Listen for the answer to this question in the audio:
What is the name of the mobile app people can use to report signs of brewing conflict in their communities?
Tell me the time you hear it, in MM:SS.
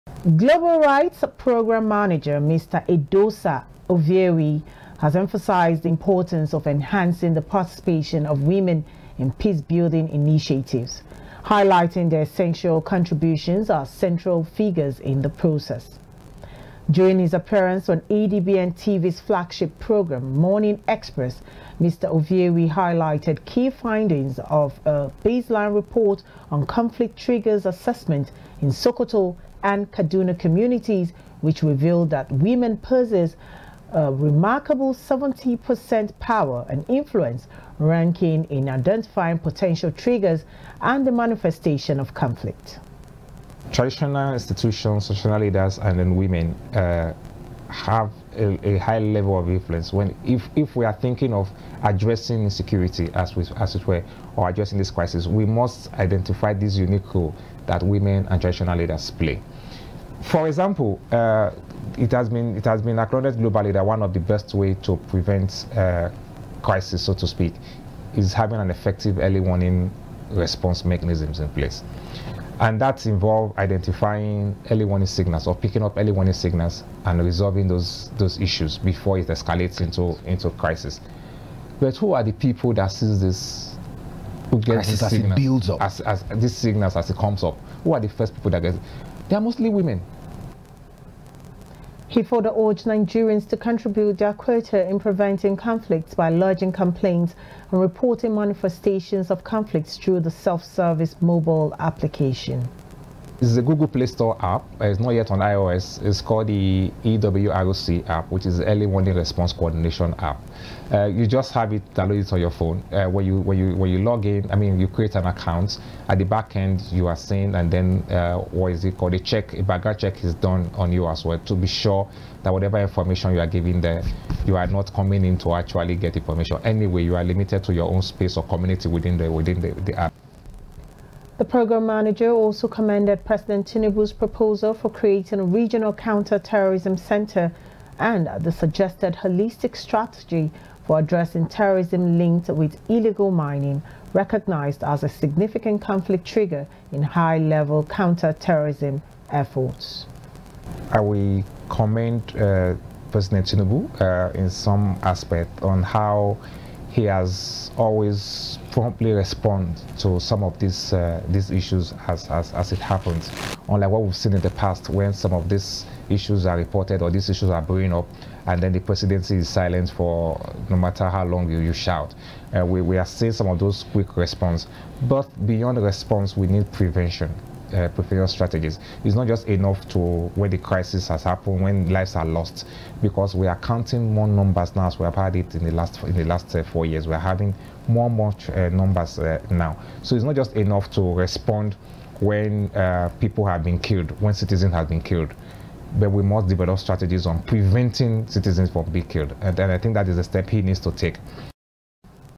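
01:47.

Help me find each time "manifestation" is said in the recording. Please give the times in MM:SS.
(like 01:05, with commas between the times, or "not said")
00:41, 01:38.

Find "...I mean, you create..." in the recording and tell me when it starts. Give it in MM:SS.
01:54.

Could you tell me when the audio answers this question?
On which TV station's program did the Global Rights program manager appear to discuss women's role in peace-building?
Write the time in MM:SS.
00:18.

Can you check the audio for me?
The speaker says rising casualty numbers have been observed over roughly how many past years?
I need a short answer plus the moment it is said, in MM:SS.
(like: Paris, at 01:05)
4, at 03:06.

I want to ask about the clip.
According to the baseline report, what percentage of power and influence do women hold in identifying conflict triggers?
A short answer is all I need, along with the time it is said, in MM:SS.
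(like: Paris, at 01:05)
70%, at 00:34.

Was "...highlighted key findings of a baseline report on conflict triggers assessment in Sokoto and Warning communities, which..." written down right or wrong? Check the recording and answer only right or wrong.
wrong.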